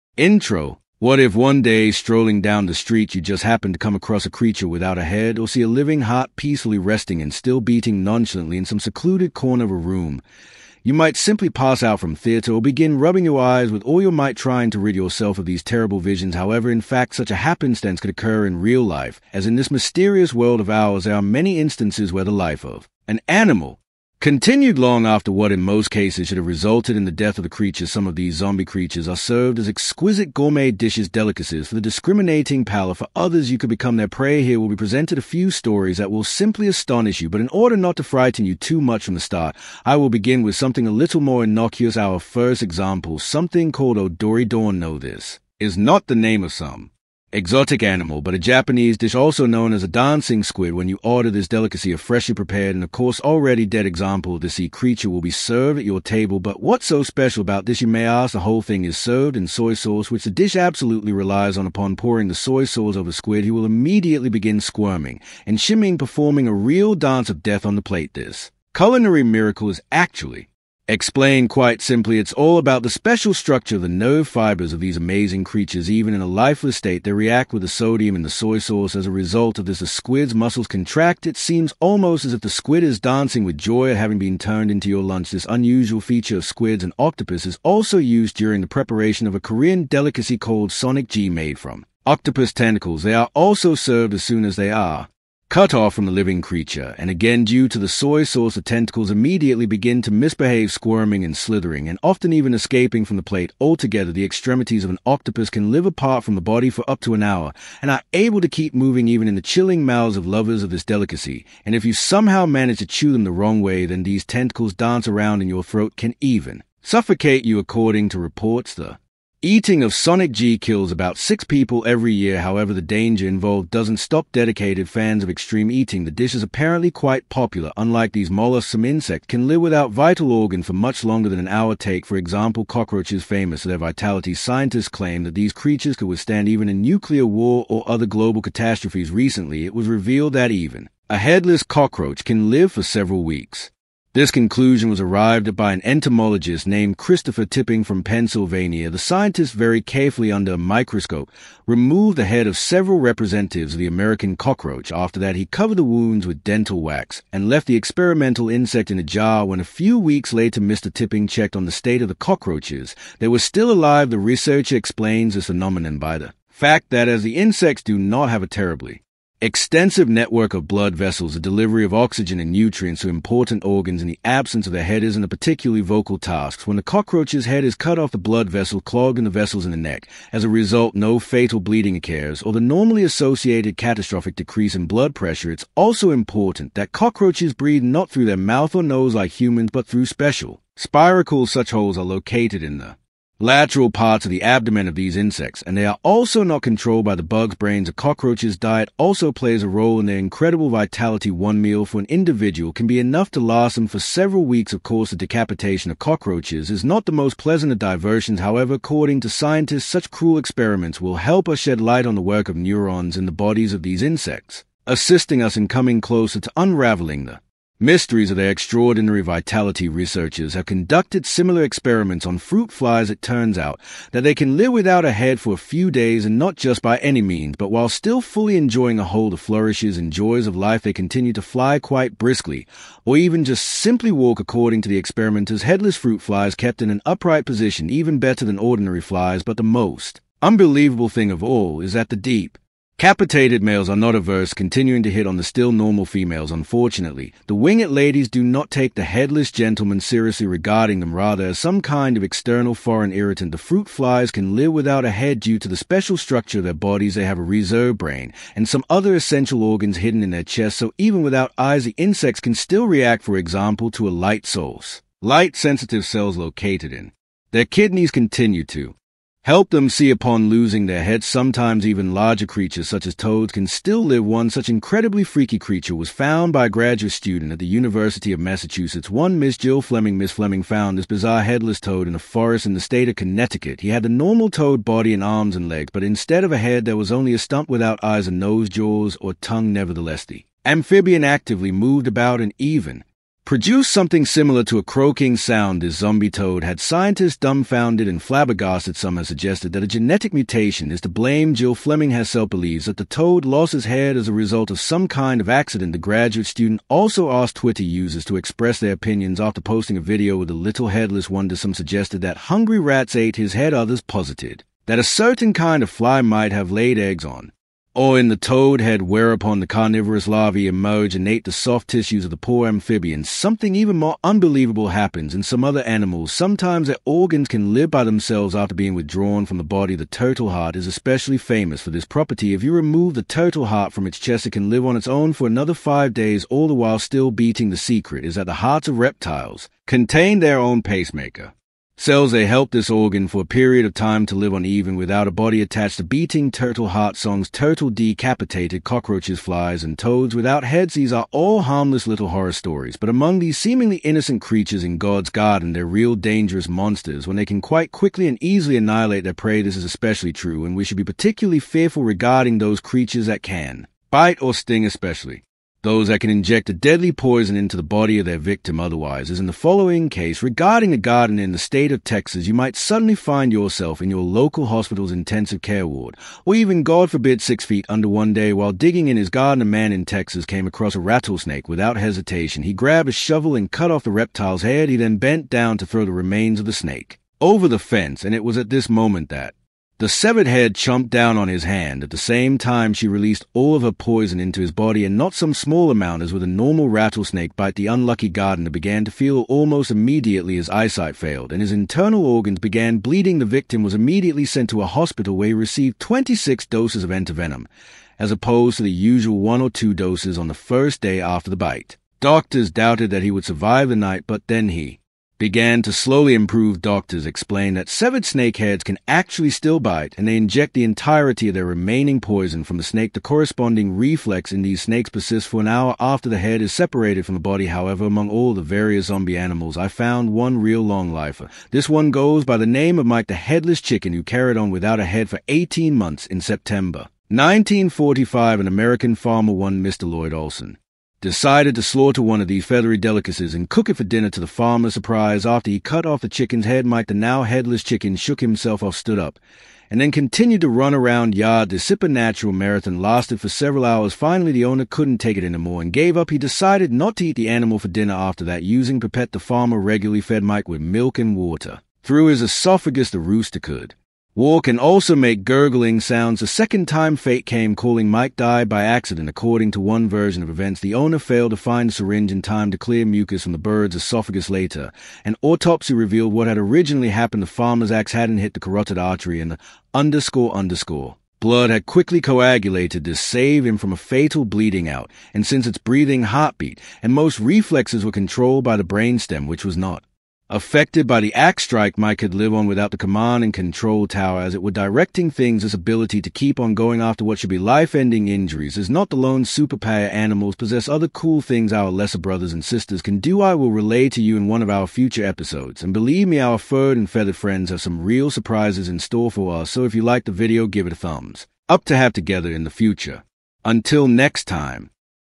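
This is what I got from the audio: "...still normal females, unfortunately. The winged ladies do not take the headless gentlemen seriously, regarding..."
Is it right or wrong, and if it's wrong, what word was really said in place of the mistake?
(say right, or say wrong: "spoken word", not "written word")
right.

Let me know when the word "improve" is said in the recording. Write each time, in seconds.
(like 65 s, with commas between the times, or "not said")
416 s.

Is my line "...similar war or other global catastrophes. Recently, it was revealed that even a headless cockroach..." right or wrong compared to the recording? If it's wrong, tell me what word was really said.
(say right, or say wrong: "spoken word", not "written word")
wrong: "nuclear", not "similar".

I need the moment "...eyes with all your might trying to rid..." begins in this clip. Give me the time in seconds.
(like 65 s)
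13 s.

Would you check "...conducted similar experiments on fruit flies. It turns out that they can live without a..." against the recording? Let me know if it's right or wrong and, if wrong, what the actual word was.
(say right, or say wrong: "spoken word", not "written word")
right.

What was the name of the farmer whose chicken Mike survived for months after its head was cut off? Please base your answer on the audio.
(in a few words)
Lloyd Olson.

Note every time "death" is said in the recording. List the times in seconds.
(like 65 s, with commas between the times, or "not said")
27 s, 67 s.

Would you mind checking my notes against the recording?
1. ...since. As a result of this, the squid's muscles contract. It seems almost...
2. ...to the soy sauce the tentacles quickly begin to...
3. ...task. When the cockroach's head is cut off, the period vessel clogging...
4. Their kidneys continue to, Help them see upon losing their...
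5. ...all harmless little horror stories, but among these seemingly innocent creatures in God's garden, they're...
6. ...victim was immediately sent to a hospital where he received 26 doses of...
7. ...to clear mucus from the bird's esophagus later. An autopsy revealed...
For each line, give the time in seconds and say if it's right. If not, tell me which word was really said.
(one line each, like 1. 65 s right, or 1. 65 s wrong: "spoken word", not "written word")
1. 78 s wrong: "sauce", not "since"
2. 97 s wrong: "immediately", not "quickly"
3. 176 s wrong: "blood", not "period"
4. 267 s right
5. 351 s right
6. 403 s right
7. 472 s right.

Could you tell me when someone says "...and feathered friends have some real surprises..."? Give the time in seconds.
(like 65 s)
506 s.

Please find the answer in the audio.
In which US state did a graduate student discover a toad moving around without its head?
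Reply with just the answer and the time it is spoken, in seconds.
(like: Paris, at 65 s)
Connecticut, at 283 s.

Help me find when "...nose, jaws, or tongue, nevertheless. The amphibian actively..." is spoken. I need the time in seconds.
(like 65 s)
288 s.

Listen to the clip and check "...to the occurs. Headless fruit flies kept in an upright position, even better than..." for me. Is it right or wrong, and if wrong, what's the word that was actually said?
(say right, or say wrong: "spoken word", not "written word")
wrong: "experimenters", not "occurs".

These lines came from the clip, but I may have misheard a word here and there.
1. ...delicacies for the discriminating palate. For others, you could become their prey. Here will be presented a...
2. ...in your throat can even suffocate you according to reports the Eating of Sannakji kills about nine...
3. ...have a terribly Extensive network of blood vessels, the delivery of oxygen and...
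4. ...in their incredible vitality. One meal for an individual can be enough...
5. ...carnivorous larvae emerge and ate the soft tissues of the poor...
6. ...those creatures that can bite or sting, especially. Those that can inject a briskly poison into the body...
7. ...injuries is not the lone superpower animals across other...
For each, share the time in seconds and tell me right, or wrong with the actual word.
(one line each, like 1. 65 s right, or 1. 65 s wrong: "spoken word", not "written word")
1. 31 s right
2. 115 s wrong: "six", not "nine"
3. 168 s right
4. 199 s right
5. 319 s right
6. 362 s wrong: "deadly", not "briskly"
7. 498 s wrong: "possess", not "across".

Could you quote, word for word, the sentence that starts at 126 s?
The dish is apparently quite popular.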